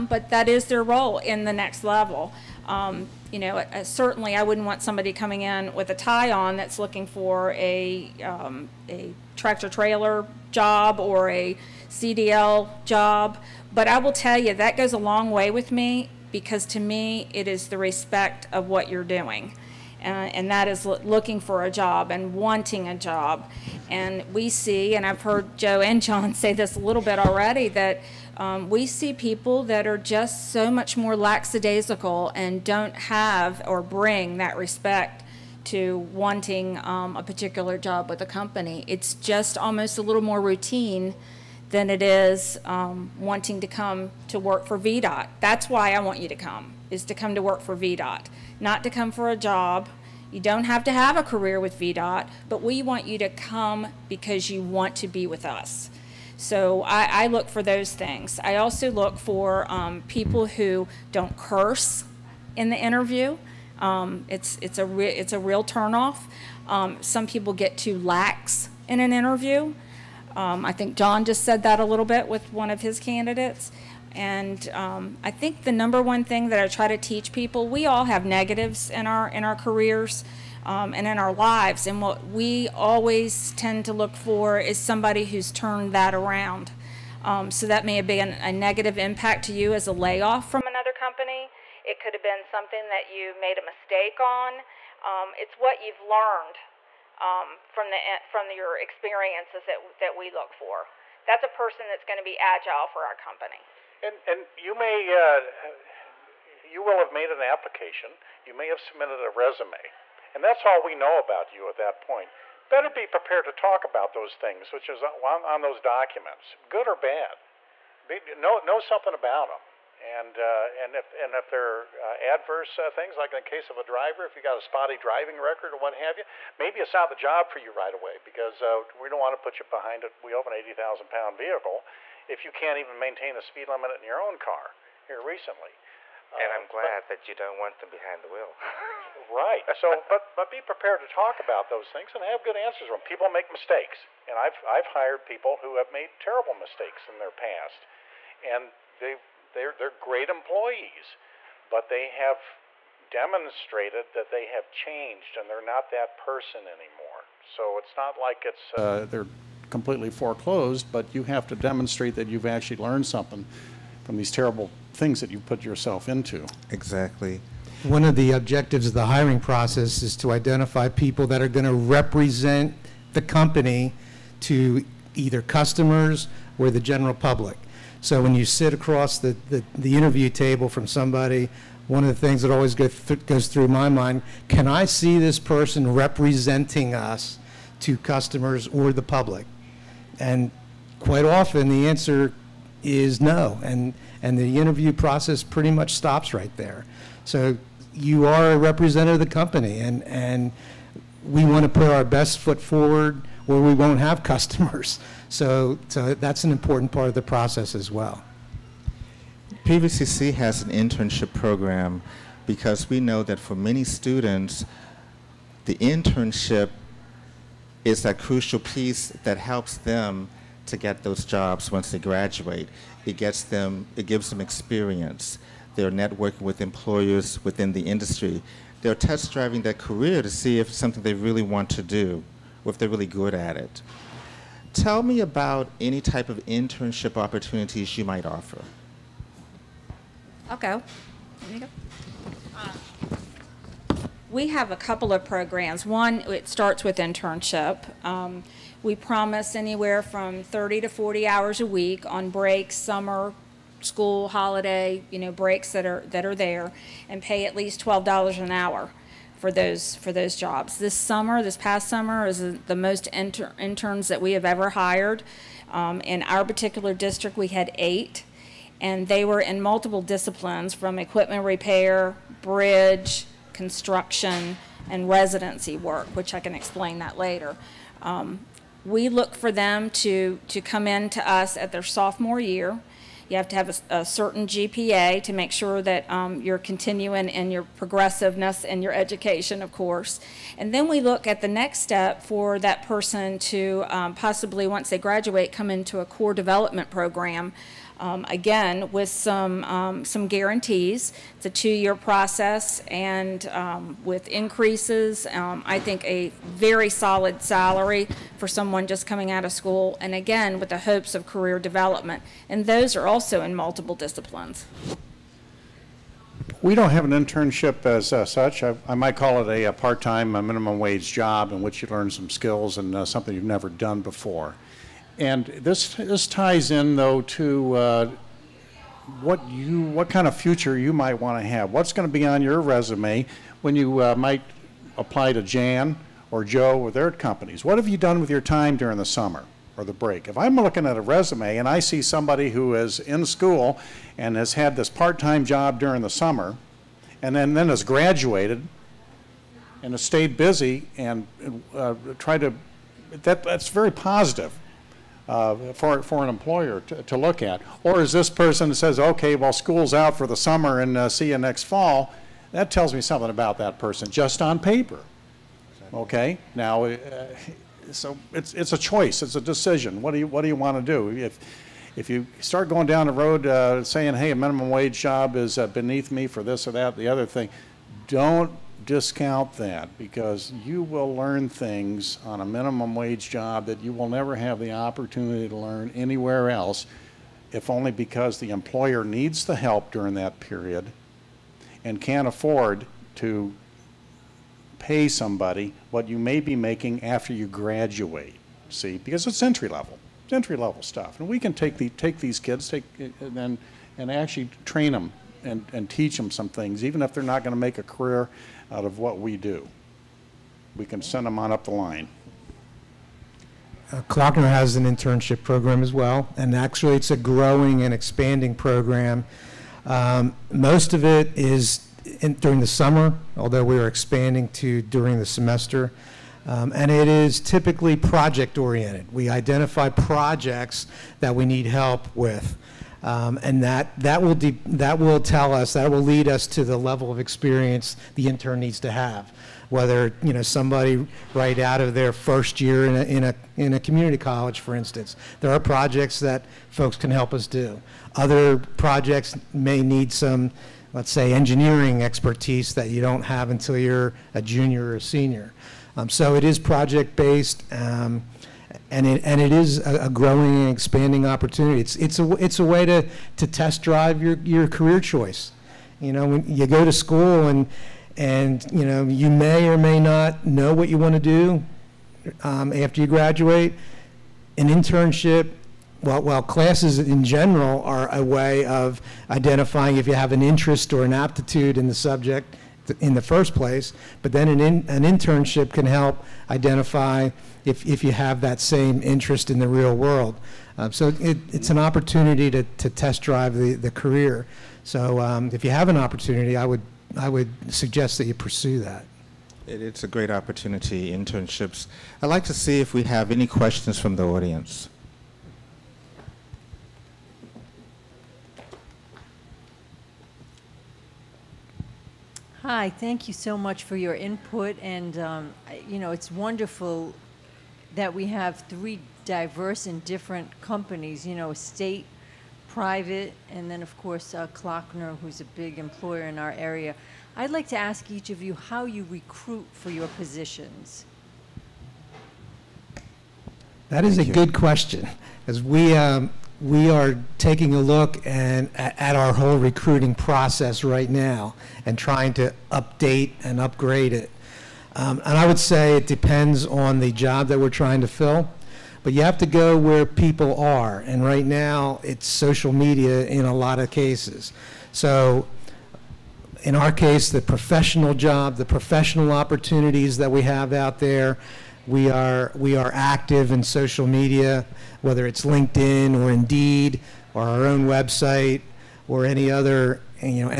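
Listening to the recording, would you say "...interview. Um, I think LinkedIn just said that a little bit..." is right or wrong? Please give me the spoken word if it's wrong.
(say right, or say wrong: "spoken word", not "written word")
wrong: "John", not "LinkedIn".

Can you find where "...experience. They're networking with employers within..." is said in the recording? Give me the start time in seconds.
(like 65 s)
224 s.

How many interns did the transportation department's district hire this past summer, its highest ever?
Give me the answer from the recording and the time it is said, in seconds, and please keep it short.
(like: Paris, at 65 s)
8, at 267 s.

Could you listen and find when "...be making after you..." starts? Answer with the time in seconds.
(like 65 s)
396 s.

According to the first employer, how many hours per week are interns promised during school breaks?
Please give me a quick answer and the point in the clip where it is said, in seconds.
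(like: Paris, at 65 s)
30 to 40, at 250 s.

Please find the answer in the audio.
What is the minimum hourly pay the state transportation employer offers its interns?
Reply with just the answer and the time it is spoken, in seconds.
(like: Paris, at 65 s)
$12, at 257 s.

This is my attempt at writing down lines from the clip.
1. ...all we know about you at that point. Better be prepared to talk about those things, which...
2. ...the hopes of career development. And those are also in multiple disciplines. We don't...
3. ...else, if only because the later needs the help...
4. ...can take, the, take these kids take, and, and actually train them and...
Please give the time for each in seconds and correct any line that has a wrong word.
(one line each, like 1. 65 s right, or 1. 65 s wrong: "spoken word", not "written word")
1. 110 s right
2. 310 s right
3. 386 s wrong: "employer", not "later"
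4. 401 s right.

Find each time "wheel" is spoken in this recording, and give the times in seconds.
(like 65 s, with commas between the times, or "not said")
130 s, 138 s.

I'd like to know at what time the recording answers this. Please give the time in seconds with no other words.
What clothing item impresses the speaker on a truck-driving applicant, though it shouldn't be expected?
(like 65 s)
5 s.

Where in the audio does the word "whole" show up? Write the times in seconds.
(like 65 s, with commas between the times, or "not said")
539 s.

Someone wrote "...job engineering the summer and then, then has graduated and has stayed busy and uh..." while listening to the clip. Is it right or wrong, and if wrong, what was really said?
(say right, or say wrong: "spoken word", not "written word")
wrong: "during", not "engineering".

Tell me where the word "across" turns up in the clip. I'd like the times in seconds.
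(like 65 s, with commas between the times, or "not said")
178 s.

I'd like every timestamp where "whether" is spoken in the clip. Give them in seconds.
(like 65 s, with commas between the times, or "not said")
439 s, 565 s.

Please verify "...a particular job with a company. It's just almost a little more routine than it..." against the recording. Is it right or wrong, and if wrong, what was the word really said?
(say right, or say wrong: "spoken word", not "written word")
right.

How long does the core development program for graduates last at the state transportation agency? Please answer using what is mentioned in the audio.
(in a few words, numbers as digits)
2 years.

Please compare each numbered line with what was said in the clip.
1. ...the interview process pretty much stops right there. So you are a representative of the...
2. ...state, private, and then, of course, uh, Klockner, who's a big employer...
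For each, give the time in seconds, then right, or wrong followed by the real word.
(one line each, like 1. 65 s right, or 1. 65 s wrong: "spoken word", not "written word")
1. 194 s right
2. 521 s right.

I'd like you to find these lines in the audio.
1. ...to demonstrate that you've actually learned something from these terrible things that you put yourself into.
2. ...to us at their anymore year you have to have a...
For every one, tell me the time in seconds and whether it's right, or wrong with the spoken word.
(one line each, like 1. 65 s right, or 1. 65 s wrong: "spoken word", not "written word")
1. 161 s right
2. 281 s wrong: "sophomore", not "anymore".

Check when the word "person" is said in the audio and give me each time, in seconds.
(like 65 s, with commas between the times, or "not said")
101 s, 156 s, 185 s, 292 s, 358 s, 363 s.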